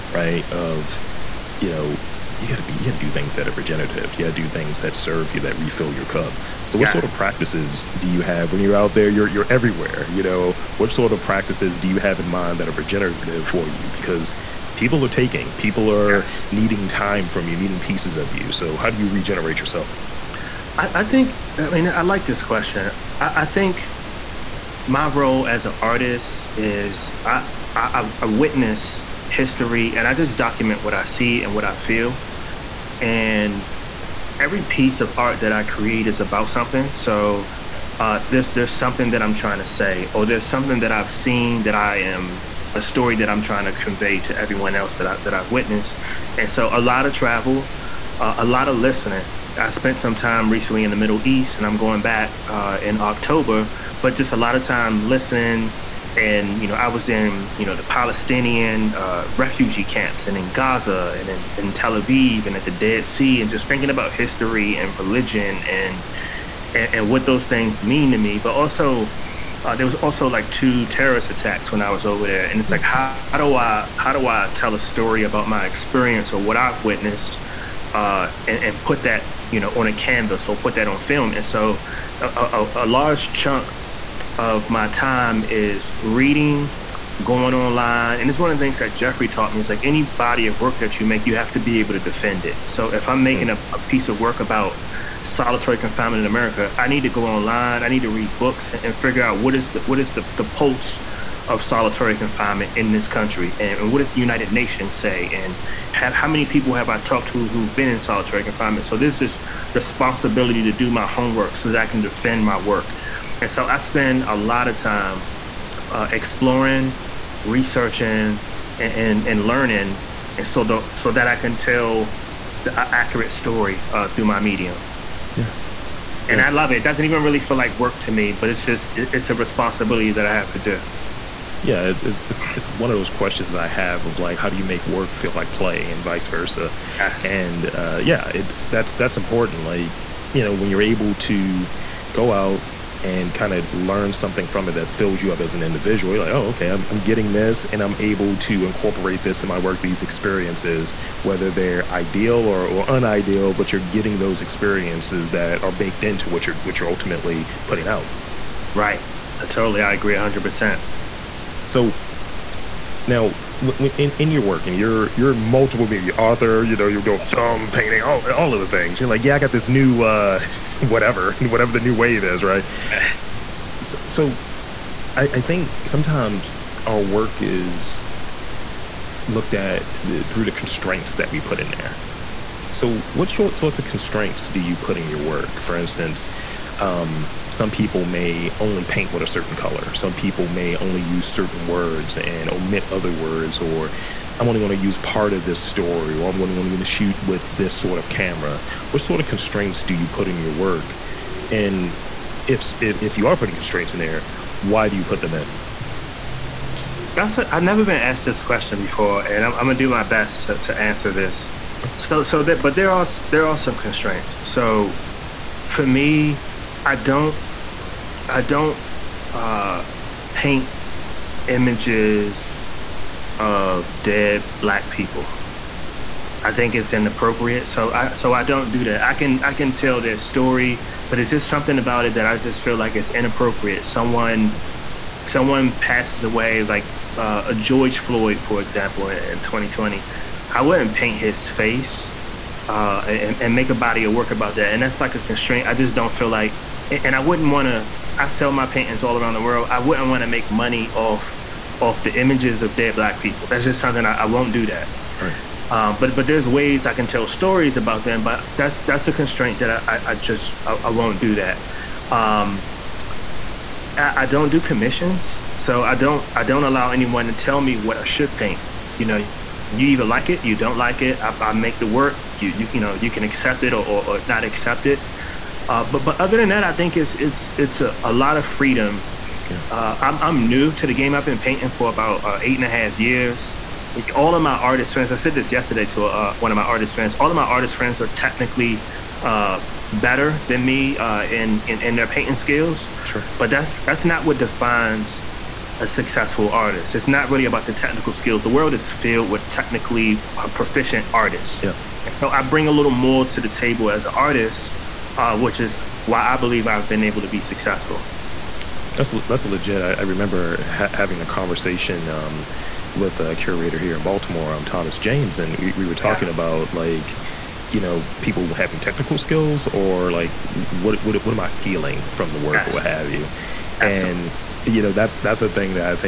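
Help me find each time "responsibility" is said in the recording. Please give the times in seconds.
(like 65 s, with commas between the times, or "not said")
109 s, 129 s.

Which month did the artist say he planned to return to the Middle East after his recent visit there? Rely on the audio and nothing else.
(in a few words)
October.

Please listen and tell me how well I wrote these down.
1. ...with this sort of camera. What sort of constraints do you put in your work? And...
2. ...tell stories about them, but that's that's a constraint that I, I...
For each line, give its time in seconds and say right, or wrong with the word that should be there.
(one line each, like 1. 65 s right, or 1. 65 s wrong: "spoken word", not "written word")
1. 197 s right
2. 257 s right.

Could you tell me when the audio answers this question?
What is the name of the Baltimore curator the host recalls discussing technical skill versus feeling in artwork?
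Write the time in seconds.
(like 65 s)
314 s.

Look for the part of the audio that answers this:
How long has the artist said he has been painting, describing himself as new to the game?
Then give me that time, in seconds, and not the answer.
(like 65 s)
282 s.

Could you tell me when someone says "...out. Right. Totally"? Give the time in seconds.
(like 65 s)
157 s.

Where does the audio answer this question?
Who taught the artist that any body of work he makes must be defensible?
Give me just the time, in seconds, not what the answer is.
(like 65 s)
88 s.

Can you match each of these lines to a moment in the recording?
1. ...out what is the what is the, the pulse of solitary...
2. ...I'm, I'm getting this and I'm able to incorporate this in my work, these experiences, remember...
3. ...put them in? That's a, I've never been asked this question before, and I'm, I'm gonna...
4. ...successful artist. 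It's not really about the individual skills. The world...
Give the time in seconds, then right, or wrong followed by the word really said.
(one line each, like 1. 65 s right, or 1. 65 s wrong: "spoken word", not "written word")
1. 99 s right
2. 146 s wrong: "whether", not "remember"
3. 205 s right
4. 295 s wrong: "technical", not "individual".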